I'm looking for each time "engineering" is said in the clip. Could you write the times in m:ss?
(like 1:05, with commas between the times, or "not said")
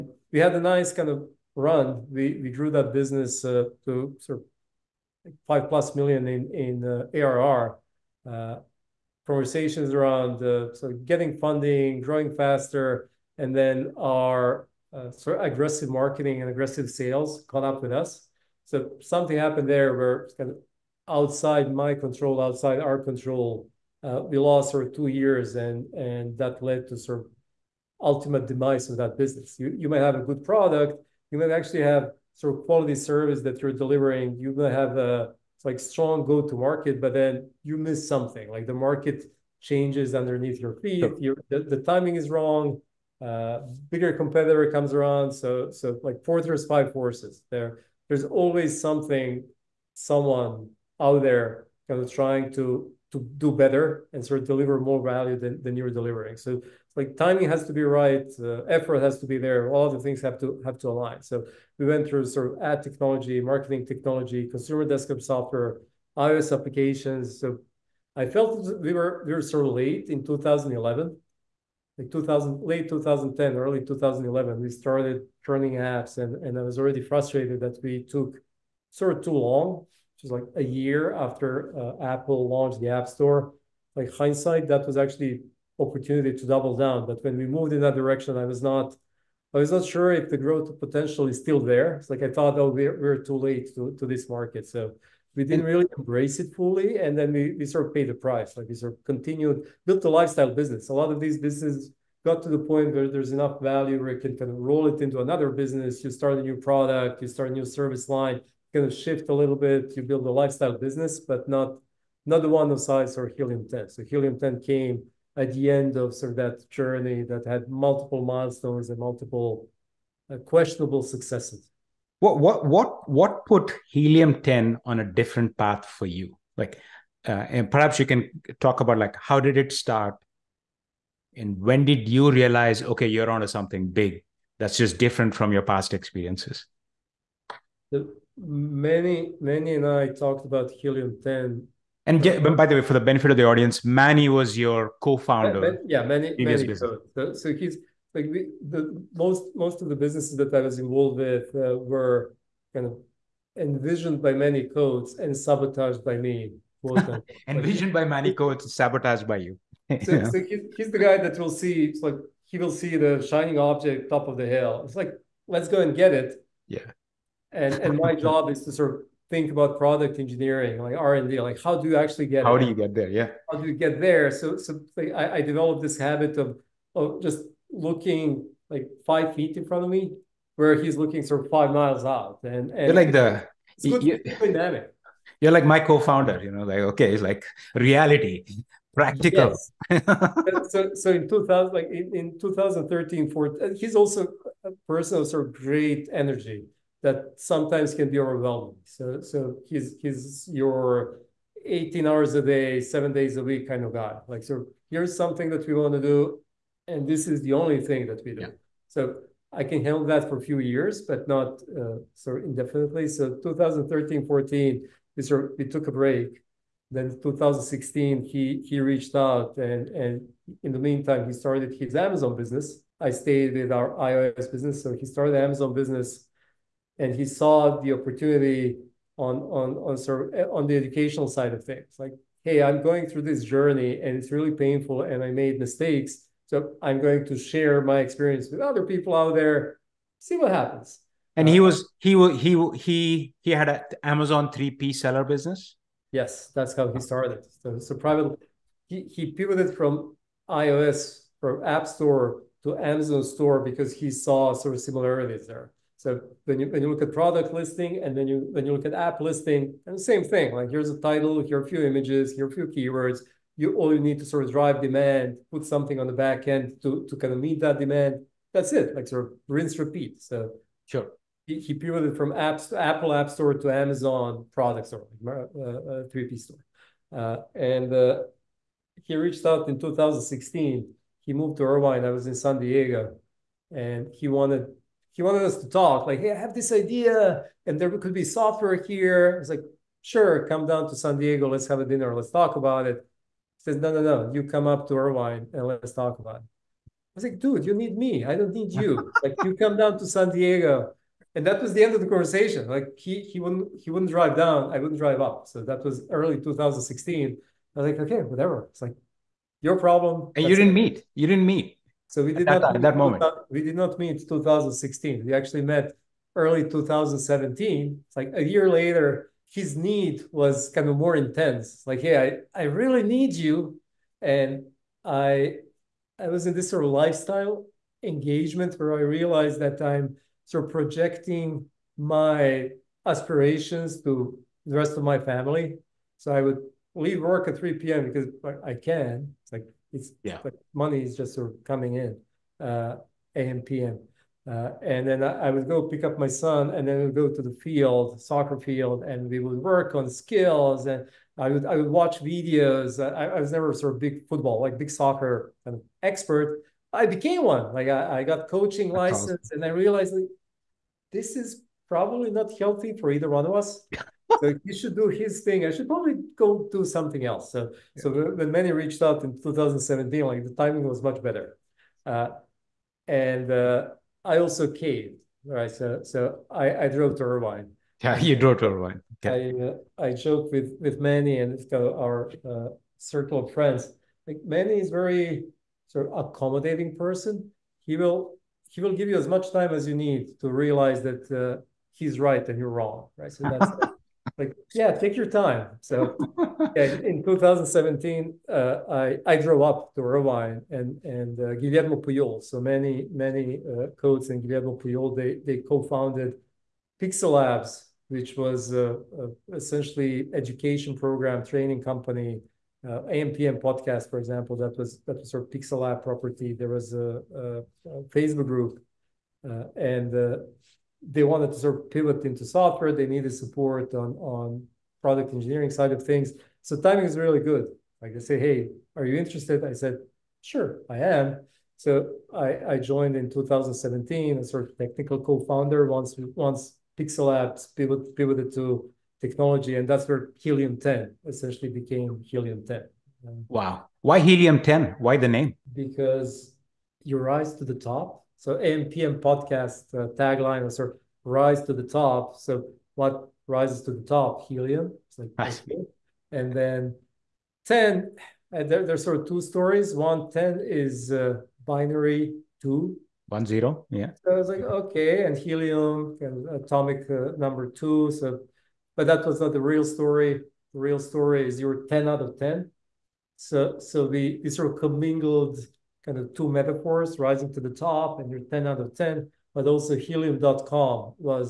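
2:50, 7:05.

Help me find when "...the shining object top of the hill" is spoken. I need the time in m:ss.
2:42.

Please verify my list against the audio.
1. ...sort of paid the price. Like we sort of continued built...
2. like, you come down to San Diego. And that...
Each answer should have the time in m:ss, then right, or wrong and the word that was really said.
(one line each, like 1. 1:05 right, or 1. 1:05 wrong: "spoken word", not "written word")
1. 1:37 right
2. 4:59 right.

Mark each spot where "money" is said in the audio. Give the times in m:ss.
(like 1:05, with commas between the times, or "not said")
5:40.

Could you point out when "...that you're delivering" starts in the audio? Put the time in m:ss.
0:33.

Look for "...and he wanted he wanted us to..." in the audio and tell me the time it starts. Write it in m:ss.
4:43.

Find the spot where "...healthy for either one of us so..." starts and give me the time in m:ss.
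6:02.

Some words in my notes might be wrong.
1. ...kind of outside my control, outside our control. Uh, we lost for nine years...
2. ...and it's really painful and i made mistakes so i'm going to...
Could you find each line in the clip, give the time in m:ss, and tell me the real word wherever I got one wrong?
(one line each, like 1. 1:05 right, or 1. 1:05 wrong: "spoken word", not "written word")
1. 0:20 wrong: "two", not "nine"
2. 3:54 right.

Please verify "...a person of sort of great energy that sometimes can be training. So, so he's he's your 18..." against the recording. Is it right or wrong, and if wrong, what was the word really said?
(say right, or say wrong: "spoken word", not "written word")
wrong: "overwhelming", not "training".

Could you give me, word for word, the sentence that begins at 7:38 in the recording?
Uh, there, there's sort of two stories.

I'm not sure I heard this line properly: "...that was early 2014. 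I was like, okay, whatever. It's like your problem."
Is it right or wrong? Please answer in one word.
wrong.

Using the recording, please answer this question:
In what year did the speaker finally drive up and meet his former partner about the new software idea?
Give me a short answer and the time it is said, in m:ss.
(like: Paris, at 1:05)
2017, at 5:16.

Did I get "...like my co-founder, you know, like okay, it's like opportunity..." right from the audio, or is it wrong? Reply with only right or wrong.
wrong.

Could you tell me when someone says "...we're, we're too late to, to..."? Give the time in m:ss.
1:32.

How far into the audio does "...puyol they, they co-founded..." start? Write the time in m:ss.
6:44.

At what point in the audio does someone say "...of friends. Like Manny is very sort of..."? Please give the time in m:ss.
6:23.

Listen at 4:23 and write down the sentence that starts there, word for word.
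You all you need to sort of drive demand, put something on the back end to, to kind of meet that demand.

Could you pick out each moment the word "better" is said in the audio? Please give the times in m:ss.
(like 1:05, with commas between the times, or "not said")
0:53, 6:11.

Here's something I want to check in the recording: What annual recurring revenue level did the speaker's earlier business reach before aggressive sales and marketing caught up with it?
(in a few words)
5 plus million.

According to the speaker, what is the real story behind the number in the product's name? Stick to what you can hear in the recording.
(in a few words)
10 out of 10.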